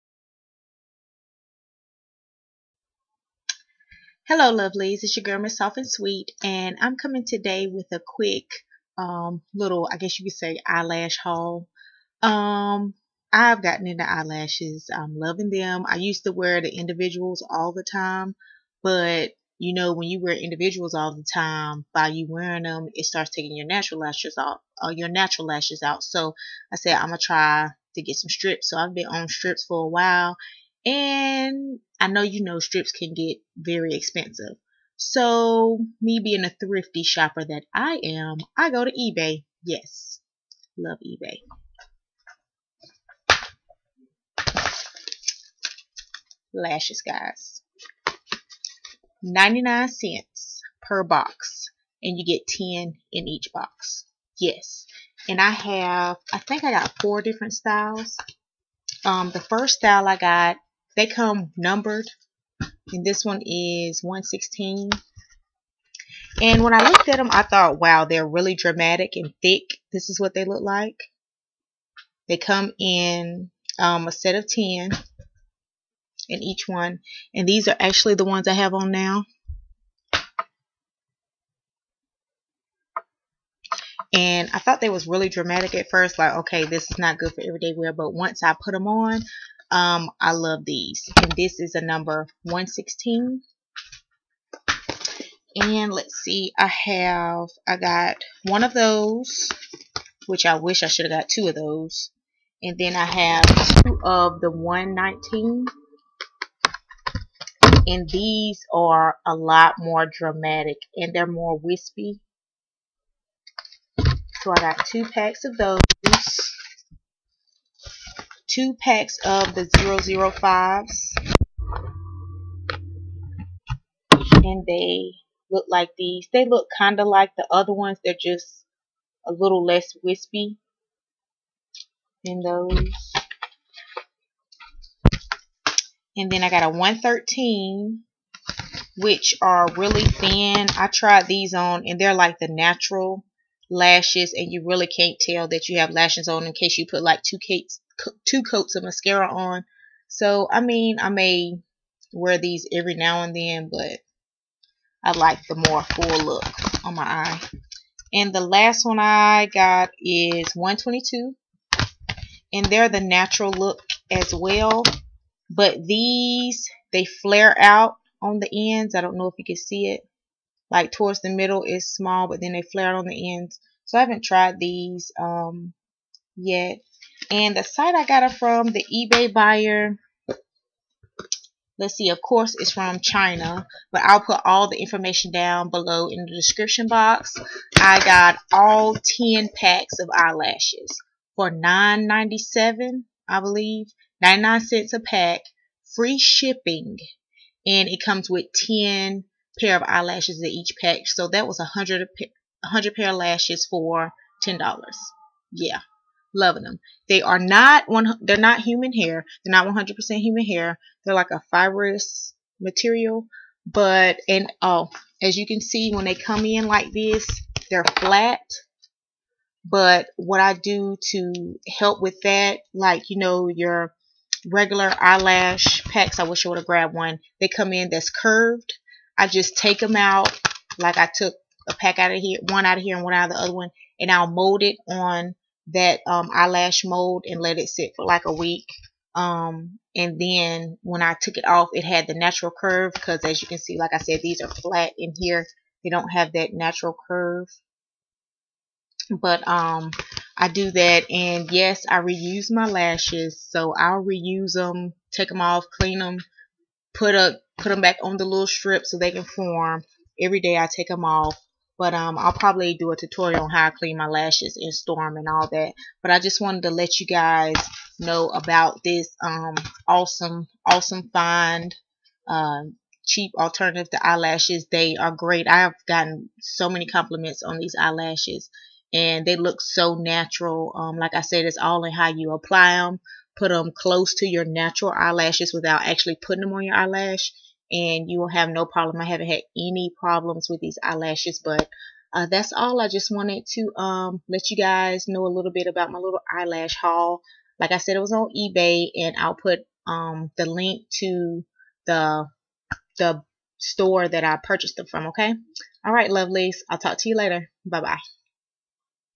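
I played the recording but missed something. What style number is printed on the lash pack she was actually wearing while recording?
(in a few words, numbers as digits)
116.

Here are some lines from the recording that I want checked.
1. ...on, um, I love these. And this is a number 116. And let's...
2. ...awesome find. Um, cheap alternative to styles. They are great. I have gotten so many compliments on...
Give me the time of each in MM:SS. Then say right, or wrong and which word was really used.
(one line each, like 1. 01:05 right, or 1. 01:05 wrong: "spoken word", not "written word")
1. 01:28 right
2. 04:30 wrong: "eyelashes", not "styles".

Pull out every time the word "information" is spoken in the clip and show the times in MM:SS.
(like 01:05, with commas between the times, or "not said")
03:04.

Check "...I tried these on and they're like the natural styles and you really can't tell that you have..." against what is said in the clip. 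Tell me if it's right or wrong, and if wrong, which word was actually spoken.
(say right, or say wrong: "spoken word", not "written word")
wrong: "lashes", not "styles".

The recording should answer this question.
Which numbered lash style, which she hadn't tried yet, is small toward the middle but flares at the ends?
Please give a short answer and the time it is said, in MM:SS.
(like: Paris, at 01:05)
122, at 02:40.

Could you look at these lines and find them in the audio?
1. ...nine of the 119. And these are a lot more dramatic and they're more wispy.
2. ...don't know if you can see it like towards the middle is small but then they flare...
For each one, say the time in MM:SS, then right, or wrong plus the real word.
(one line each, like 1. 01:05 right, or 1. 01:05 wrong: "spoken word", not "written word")
1. 01:43 wrong: "two", not "nine"
2. 02:49 right.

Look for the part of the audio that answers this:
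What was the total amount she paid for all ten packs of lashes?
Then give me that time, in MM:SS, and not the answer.
03:11.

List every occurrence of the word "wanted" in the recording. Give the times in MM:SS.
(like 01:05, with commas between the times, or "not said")
04:26, 04:53.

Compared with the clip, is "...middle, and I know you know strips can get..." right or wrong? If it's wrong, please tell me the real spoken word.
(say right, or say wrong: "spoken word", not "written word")
wrong: "while", not "middle".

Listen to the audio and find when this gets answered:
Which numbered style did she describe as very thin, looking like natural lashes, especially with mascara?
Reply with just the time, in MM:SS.
02:16.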